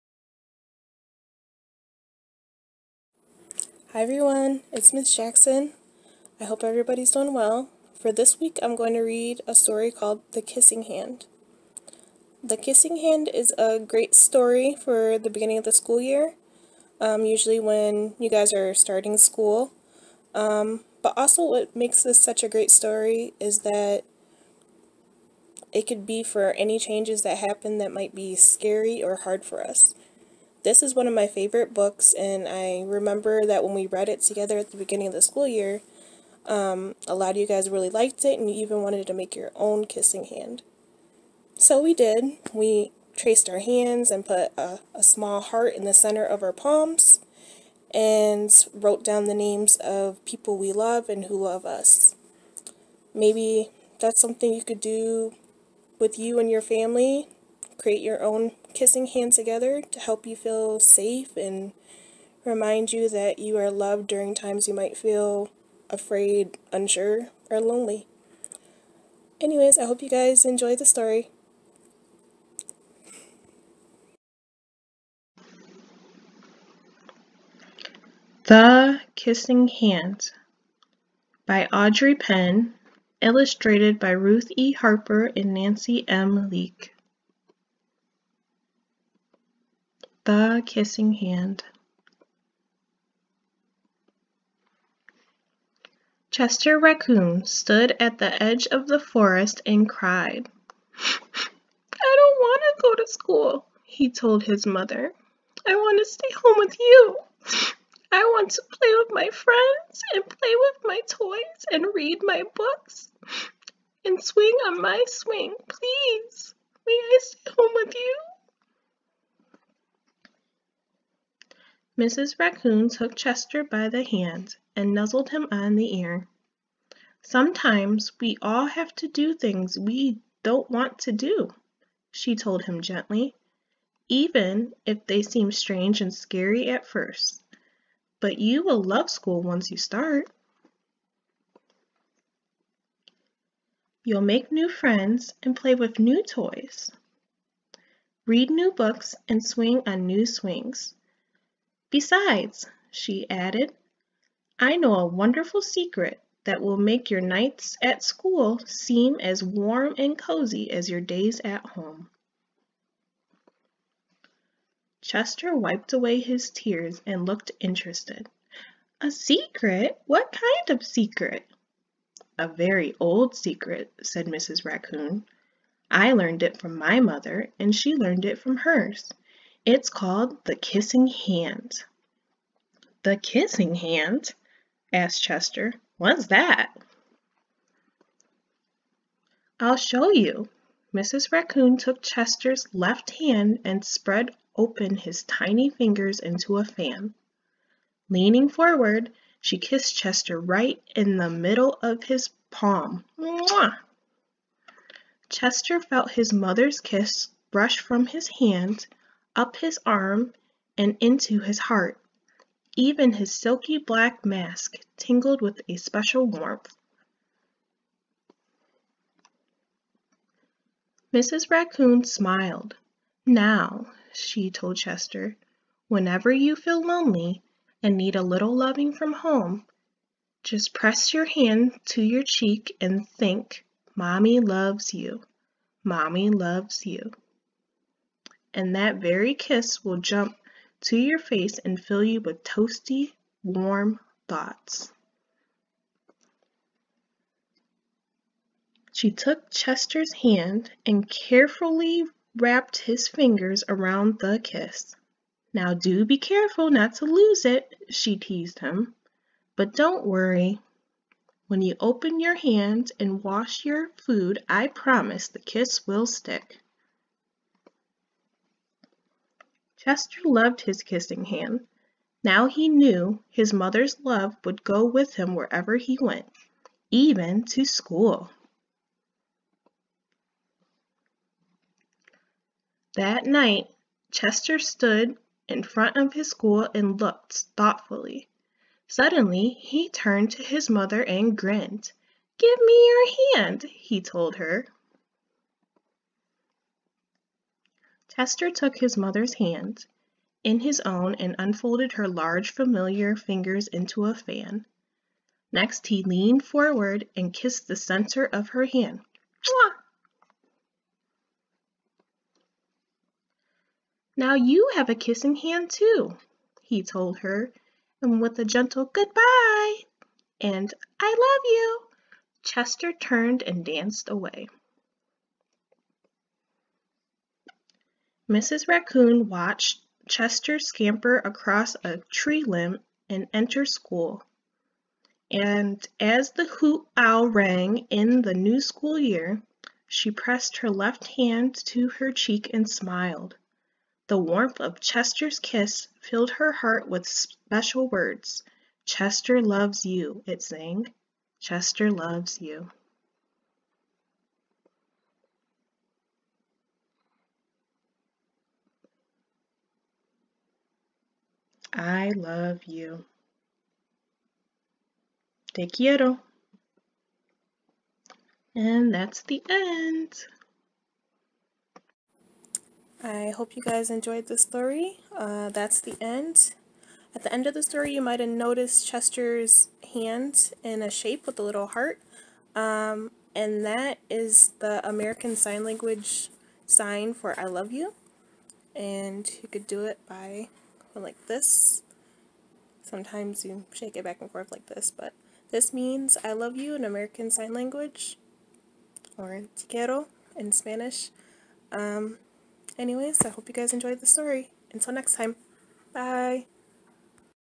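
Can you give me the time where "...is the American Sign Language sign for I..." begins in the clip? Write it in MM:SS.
06:24.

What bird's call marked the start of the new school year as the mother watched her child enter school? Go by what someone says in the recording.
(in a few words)
Hoot owl.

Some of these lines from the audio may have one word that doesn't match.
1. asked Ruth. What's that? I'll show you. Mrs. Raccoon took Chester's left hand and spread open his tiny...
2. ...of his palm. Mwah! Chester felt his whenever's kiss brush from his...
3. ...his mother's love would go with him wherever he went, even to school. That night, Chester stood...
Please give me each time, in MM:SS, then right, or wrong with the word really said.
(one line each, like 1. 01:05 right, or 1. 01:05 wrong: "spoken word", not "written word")
1. 03:04 wrong: "Chester", not "Ruth"
2. 03:21 wrong: "mother", not "whenever"
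3. 04:33 right.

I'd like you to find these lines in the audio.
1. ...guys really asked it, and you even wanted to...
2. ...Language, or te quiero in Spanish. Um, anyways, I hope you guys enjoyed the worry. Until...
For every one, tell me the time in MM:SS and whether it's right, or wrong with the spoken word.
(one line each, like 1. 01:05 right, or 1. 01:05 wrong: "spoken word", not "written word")
1. 00:37 wrong: "liked", not "asked"
2. 06:37 wrong: "story", not "worry".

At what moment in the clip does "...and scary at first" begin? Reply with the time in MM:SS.
02:16.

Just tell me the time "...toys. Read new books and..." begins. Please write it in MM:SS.
02:26.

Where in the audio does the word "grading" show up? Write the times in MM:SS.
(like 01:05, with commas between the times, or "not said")
not said.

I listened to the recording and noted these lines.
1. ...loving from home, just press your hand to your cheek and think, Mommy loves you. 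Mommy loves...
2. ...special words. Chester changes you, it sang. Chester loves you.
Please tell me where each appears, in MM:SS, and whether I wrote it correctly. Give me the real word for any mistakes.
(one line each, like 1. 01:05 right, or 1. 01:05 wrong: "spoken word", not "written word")
1. 03:48 right
2. 05:47 wrong: "loves", not "changes".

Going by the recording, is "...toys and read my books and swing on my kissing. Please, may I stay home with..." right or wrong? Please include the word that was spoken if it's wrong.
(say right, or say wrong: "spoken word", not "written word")
wrong: "swing", not "kissing".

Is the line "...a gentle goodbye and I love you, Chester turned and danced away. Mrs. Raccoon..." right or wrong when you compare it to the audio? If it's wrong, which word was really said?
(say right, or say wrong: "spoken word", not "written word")
right.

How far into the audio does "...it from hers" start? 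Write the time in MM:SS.
02:58.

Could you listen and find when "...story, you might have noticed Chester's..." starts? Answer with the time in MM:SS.
06:17.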